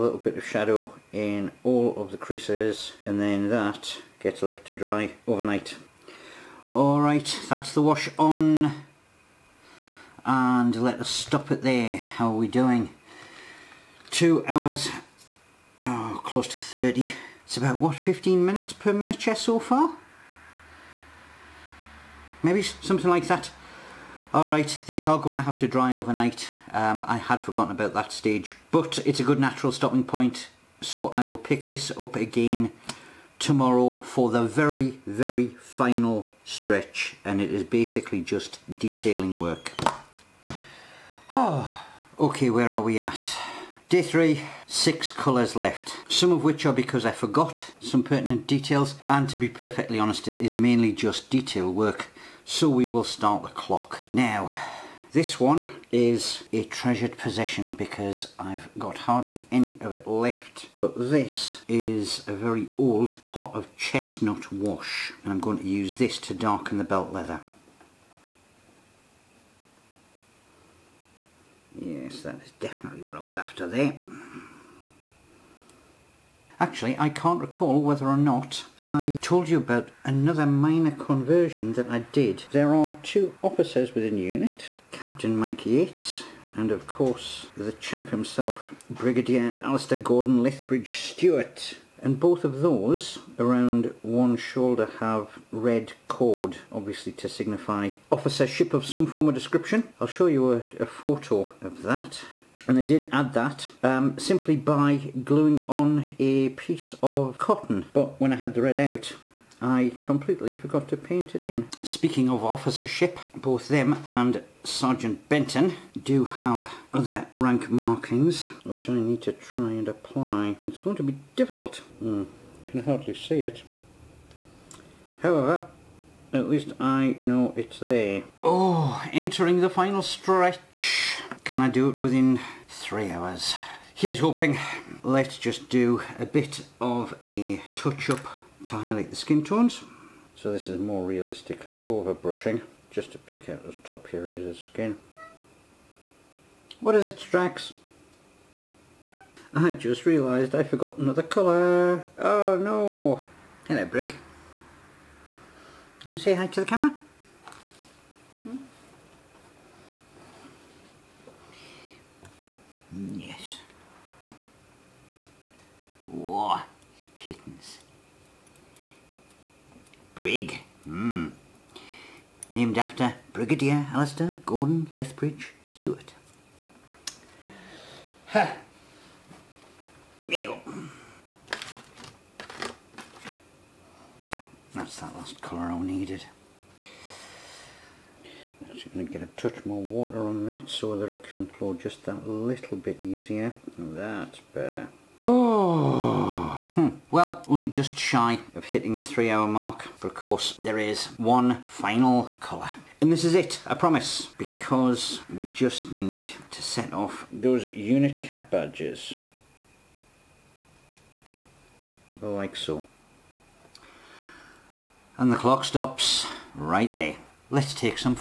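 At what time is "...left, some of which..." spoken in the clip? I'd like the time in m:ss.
0:45.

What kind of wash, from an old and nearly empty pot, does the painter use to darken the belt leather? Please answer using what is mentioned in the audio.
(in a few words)
chestnut wash.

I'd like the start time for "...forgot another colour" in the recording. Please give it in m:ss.
2:30.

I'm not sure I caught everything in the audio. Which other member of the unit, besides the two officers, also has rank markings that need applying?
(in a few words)
Sergeant Benton.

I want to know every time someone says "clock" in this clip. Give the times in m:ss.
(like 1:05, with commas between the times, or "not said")
0:53, 3:35.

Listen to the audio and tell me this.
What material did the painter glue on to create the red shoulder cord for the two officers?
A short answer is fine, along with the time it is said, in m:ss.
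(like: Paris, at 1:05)
cotton, at 1:47.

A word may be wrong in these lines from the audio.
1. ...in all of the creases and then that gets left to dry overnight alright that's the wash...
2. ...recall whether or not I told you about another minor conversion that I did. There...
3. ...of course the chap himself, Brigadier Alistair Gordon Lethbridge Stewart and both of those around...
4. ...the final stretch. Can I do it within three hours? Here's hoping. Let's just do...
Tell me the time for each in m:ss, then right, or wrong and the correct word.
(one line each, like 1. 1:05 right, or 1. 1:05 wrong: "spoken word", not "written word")
1. 0:01 right
2. 1:17 right
3. 1:26 right
4. 2:09 right.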